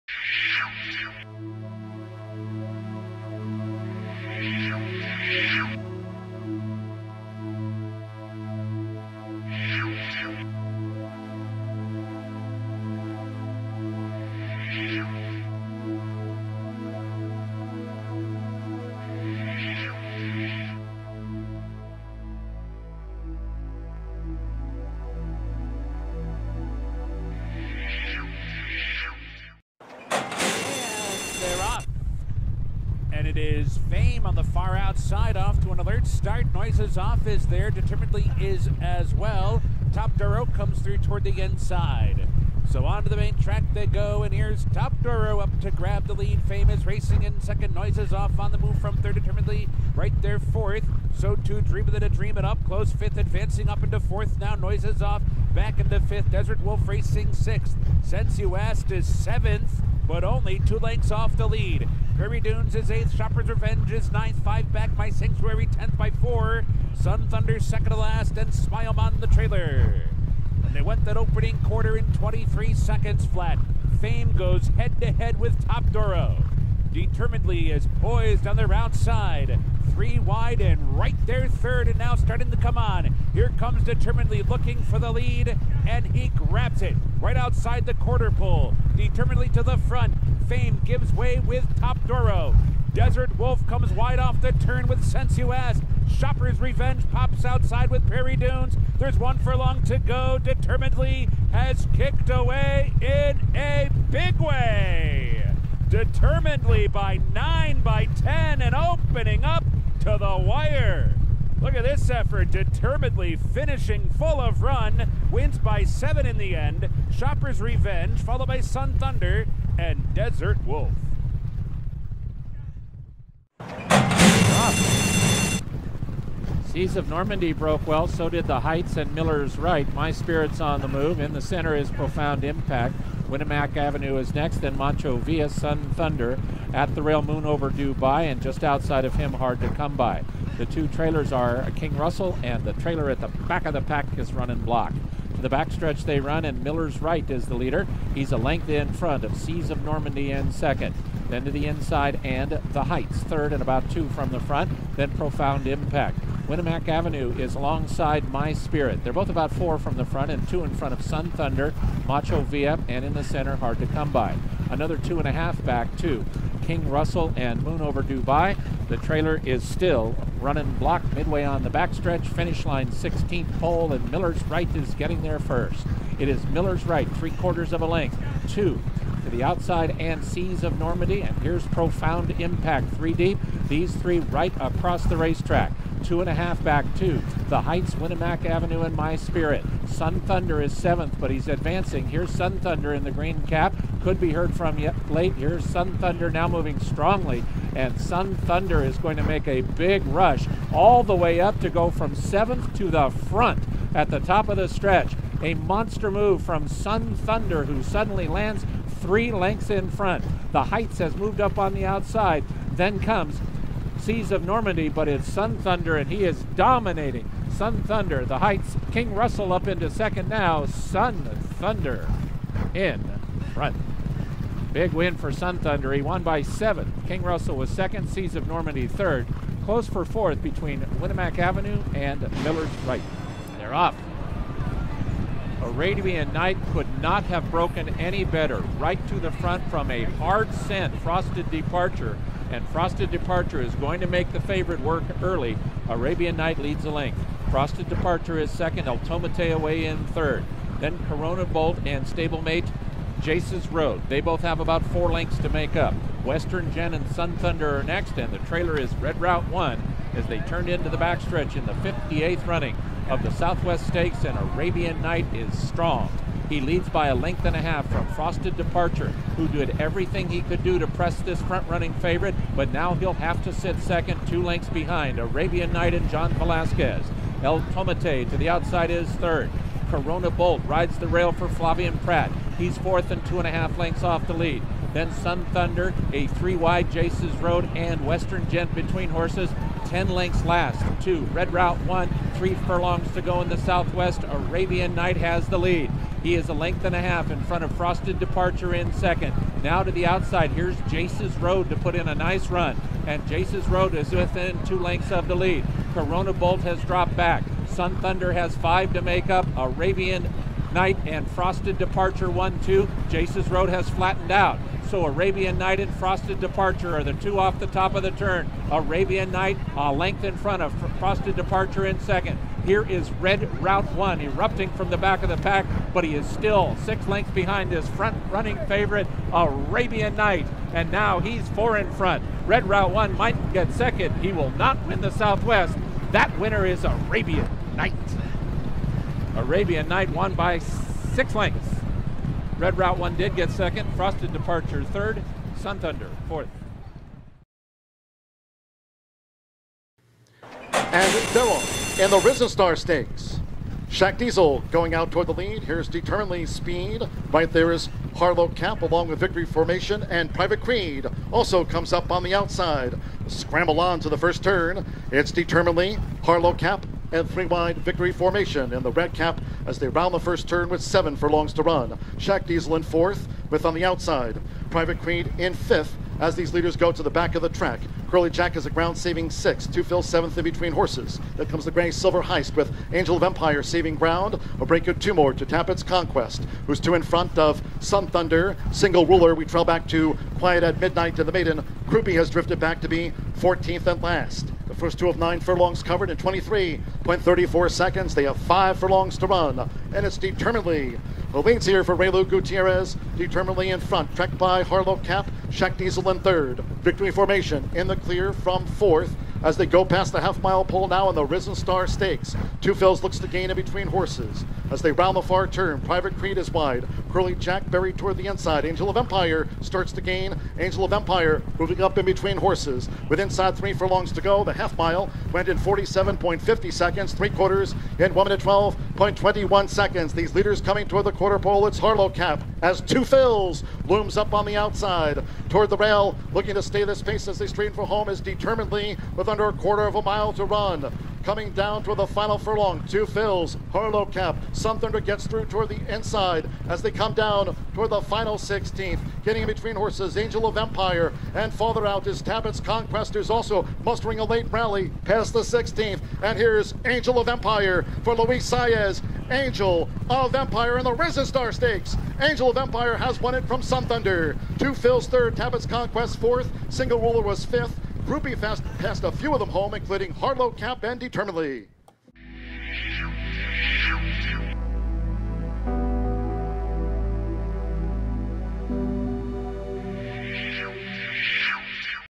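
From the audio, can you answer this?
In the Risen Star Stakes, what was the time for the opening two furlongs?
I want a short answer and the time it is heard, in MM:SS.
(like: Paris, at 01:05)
23.34 seconds, at 06:36.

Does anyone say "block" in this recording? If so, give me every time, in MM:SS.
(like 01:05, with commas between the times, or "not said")
02:24, 02:50.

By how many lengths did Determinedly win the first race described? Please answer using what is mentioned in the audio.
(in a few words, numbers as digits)
7.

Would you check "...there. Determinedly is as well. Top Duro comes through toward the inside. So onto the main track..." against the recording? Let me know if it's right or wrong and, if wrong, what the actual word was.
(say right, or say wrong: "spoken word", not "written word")
right.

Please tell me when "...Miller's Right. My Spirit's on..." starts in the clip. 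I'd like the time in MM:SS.
02:09.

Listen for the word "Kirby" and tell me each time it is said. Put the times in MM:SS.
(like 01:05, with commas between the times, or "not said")
01:02.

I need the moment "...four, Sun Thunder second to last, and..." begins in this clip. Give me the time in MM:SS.
01:06.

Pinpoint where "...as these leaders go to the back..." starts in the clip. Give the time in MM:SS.
06:16.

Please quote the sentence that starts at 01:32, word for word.
Desert Wolf comes wide off the turn with Sensuous, Shopper's Revenge pops outside with Prairie Dunes.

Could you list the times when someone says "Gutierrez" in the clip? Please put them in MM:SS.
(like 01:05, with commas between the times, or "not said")
06:42.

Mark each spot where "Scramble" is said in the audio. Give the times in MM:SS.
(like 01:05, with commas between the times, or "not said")
06:03.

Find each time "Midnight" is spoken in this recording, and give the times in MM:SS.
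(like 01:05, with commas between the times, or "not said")
06:30.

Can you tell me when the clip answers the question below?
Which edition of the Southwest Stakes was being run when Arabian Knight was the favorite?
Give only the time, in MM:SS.
04:21.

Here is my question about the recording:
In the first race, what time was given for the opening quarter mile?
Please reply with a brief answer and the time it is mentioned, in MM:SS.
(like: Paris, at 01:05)
23 seconds flat, at 01:12.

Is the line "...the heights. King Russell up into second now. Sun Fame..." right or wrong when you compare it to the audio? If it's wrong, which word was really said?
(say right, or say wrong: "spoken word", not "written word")
wrong: "Thunder", not "Fame".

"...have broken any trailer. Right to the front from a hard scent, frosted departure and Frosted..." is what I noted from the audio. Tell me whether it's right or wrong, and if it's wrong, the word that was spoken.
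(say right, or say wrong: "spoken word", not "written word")
wrong: "better", not "trailer".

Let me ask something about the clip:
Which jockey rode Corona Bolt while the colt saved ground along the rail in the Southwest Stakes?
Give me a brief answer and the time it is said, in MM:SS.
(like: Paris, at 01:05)
Flavien Prat, at 04:41.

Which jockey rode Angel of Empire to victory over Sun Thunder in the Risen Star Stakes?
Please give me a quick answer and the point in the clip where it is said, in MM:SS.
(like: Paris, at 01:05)
Luis Saez, at 07:38.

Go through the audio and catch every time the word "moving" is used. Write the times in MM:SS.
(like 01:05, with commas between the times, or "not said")
03:16, 07:01.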